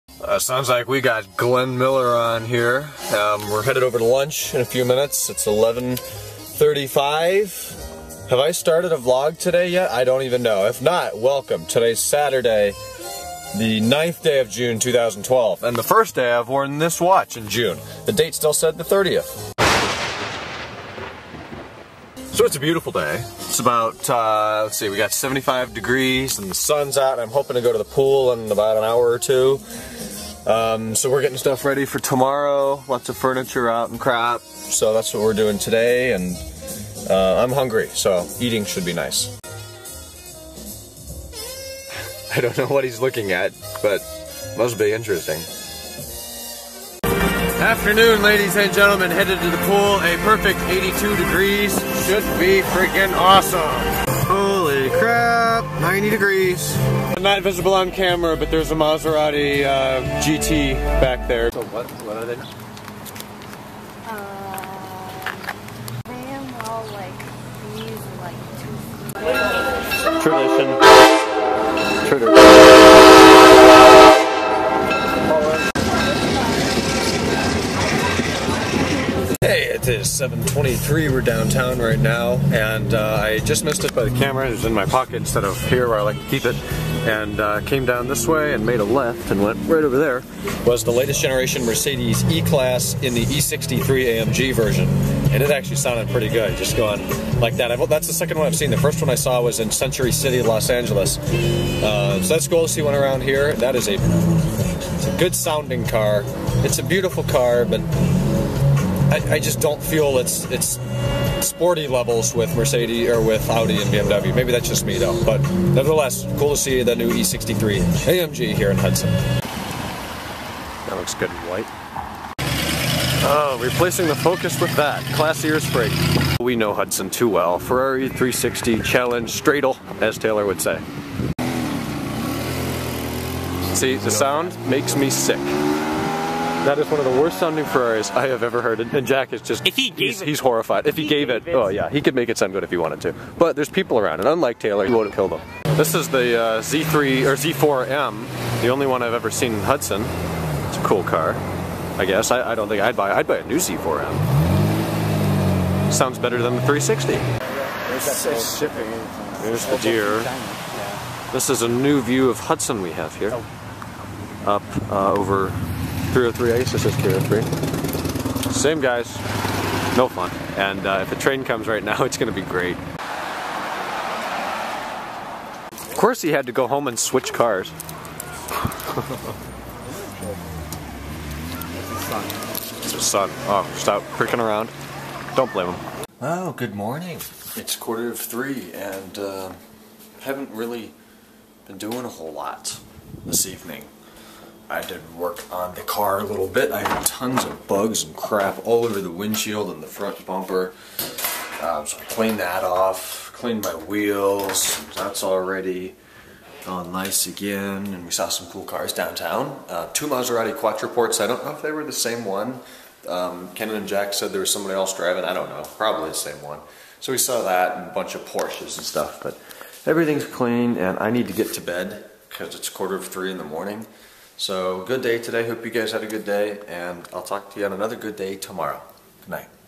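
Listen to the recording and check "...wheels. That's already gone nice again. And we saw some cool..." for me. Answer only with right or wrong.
right.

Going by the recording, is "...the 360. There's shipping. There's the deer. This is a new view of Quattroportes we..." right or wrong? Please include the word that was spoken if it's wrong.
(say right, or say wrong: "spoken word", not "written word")
wrong: "Hudson", not "Quattroportes".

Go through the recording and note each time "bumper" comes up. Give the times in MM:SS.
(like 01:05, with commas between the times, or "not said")
03:20.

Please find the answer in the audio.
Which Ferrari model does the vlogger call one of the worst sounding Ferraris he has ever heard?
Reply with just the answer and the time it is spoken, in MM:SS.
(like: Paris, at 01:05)
360 Challenge Stradale, at 02:08.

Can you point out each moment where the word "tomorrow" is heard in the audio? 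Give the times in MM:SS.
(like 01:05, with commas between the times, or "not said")
00:31, 03:48.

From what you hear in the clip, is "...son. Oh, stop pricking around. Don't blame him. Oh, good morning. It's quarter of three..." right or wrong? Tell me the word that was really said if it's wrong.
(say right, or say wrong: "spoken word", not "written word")
right.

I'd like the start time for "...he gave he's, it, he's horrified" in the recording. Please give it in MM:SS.
02:19.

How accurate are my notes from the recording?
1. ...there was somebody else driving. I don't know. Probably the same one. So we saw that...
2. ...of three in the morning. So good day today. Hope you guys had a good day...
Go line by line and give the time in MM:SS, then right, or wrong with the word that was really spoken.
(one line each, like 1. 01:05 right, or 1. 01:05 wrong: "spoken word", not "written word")
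1. 03:34 right
2. 03:42 right.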